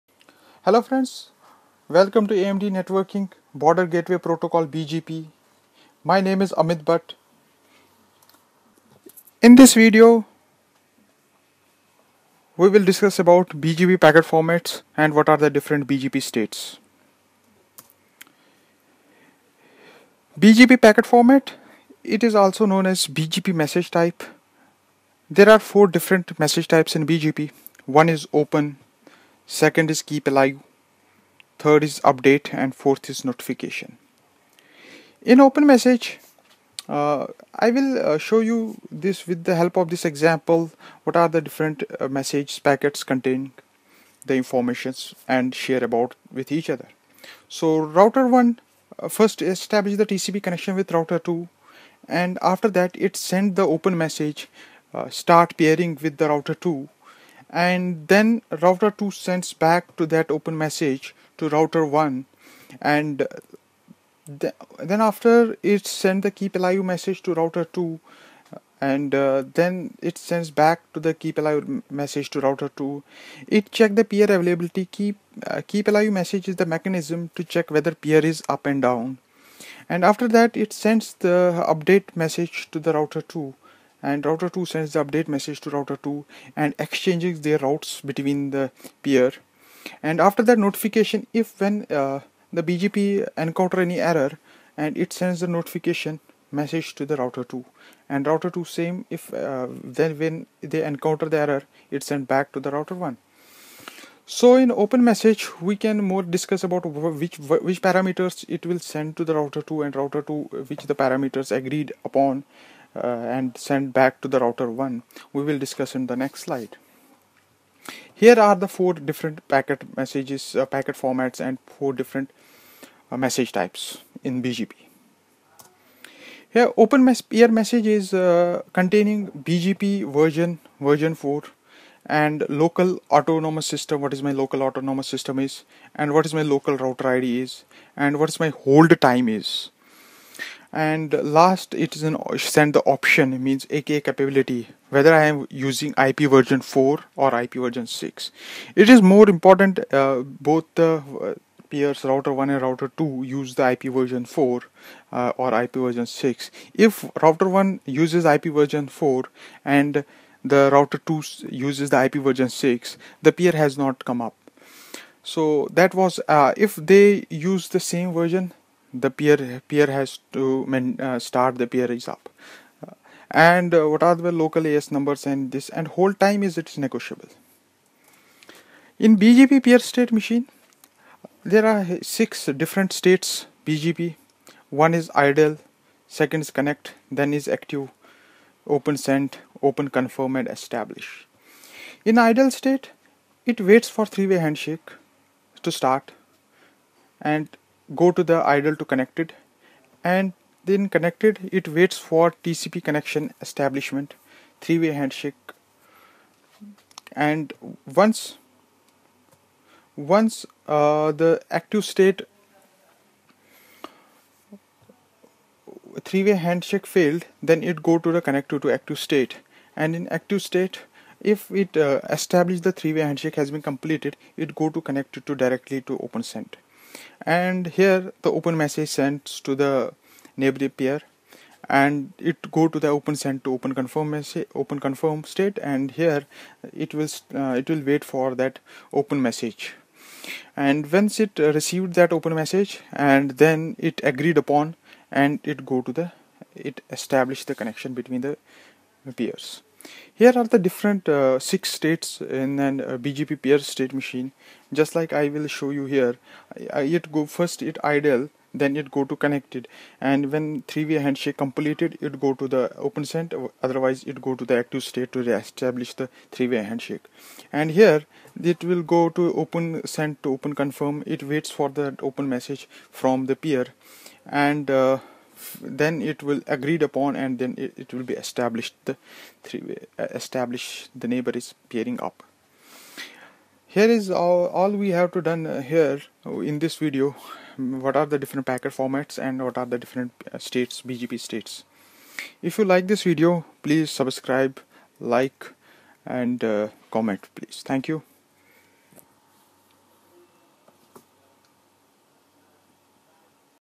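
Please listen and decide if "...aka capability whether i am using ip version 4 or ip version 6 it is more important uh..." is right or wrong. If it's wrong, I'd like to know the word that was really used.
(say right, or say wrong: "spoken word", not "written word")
right.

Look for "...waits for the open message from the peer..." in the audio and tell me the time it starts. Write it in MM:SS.
04:31.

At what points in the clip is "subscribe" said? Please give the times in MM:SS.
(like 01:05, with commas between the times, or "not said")
04:53.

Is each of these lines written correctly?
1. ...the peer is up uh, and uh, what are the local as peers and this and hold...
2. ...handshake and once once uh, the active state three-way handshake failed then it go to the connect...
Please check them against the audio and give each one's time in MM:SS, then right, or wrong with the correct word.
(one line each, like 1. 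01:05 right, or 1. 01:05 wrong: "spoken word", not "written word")
1. 02:51 wrong: "numbers", not "peers"
2. 03:24 right.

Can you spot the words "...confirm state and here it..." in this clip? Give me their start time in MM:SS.
03:54.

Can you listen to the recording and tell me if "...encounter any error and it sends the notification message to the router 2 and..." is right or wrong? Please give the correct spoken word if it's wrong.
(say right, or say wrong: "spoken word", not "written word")
right.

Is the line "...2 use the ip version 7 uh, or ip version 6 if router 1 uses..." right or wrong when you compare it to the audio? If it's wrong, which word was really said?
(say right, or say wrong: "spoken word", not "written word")
wrong: "4", not "7".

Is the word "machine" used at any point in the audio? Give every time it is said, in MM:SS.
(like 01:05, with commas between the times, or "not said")
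03:00, 04:13.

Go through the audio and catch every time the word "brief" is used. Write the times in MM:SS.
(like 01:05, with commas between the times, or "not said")
not said.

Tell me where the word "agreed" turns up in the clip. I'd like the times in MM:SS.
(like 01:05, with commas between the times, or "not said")
01:51, 04:04, 04:36.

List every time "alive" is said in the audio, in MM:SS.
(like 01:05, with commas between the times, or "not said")
00:30, 01:06, 01:11, 01:15.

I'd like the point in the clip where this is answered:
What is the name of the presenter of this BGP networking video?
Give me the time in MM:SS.
00:06.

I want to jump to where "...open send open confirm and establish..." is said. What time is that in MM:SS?
03:08.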